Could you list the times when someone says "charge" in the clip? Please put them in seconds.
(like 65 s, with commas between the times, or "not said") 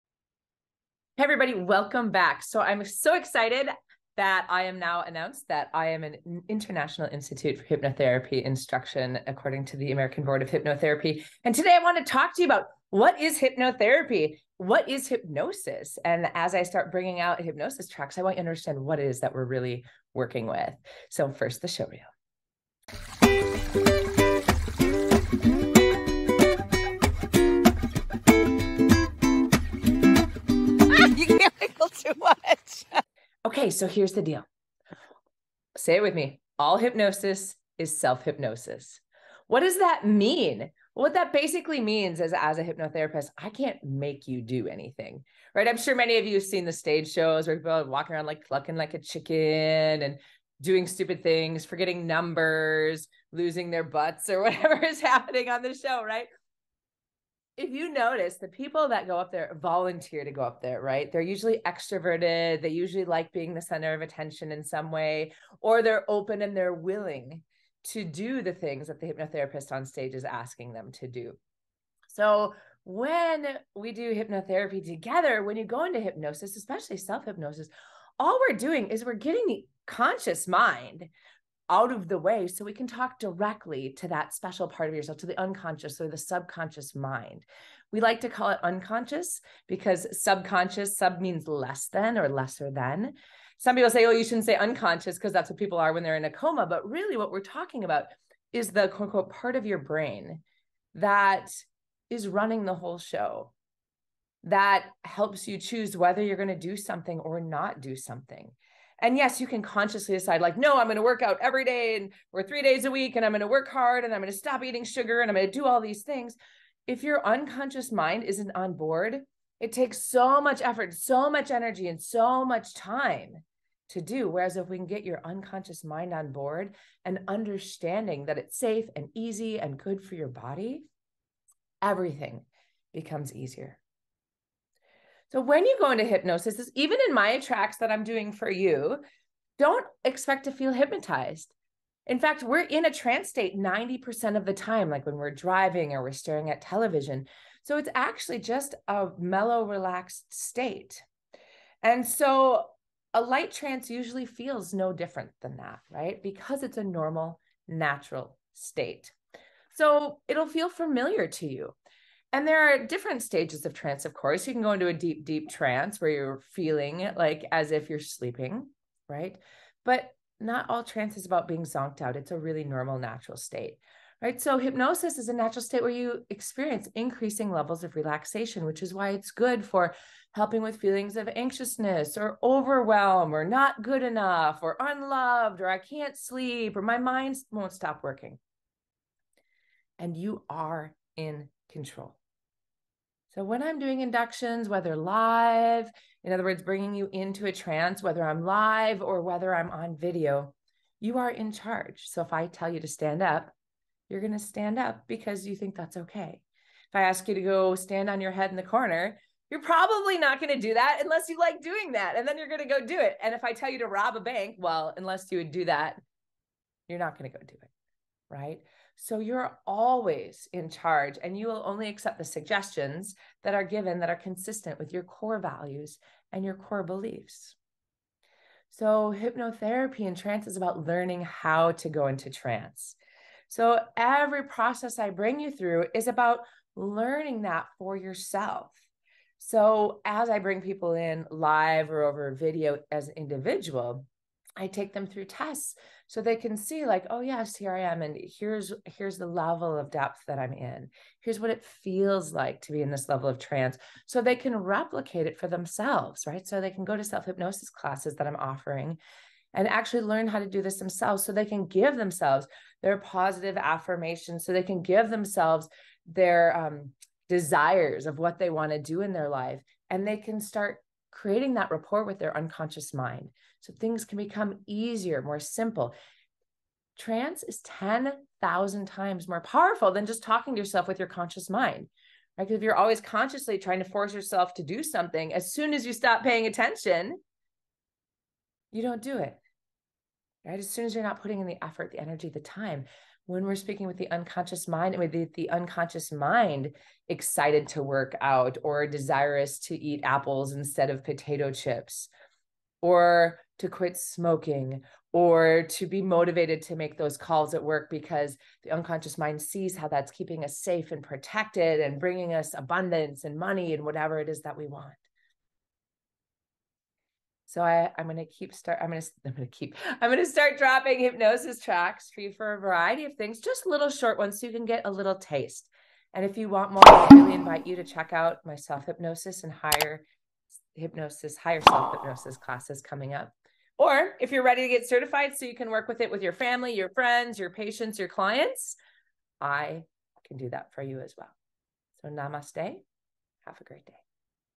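201 s, 220 s.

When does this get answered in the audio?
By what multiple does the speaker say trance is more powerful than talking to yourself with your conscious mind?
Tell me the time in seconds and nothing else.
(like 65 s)
277 s.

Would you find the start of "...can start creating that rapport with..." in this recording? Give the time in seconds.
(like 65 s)
270 s.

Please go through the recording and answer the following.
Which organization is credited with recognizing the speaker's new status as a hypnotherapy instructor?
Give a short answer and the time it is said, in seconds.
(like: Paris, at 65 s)
American Board of Hypnotherapy, at 9 s.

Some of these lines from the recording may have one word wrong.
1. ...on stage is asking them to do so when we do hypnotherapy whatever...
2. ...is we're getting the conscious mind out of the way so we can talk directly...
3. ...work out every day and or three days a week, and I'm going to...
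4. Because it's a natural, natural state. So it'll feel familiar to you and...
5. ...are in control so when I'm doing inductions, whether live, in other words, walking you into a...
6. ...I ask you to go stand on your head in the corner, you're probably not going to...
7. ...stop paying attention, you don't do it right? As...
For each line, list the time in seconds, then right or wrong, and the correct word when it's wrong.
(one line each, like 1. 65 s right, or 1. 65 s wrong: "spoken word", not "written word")
1. 69 s wrong: "together", not "whatever"
2. 78 s right
3. 111 s right
4. 156 s wrong: "normal", not "natural"
5. 190 s wrong: "bringing", not "walking"
6. 206 s right
7. 285 s right.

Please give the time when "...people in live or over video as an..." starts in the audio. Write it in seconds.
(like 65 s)
240 s.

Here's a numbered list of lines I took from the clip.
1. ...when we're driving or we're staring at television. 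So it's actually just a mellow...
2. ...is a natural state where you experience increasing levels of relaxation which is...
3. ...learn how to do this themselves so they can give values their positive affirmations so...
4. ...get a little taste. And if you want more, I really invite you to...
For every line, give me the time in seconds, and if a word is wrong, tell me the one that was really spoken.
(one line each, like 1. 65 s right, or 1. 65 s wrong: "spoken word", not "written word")
1. 145 s right
2. 175 s right
3. 260 s wrong: "themselves", not "values"
4. 324 s right.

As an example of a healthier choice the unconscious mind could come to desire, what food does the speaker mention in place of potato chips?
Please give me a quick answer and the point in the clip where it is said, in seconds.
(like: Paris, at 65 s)
Apples, at 300 s.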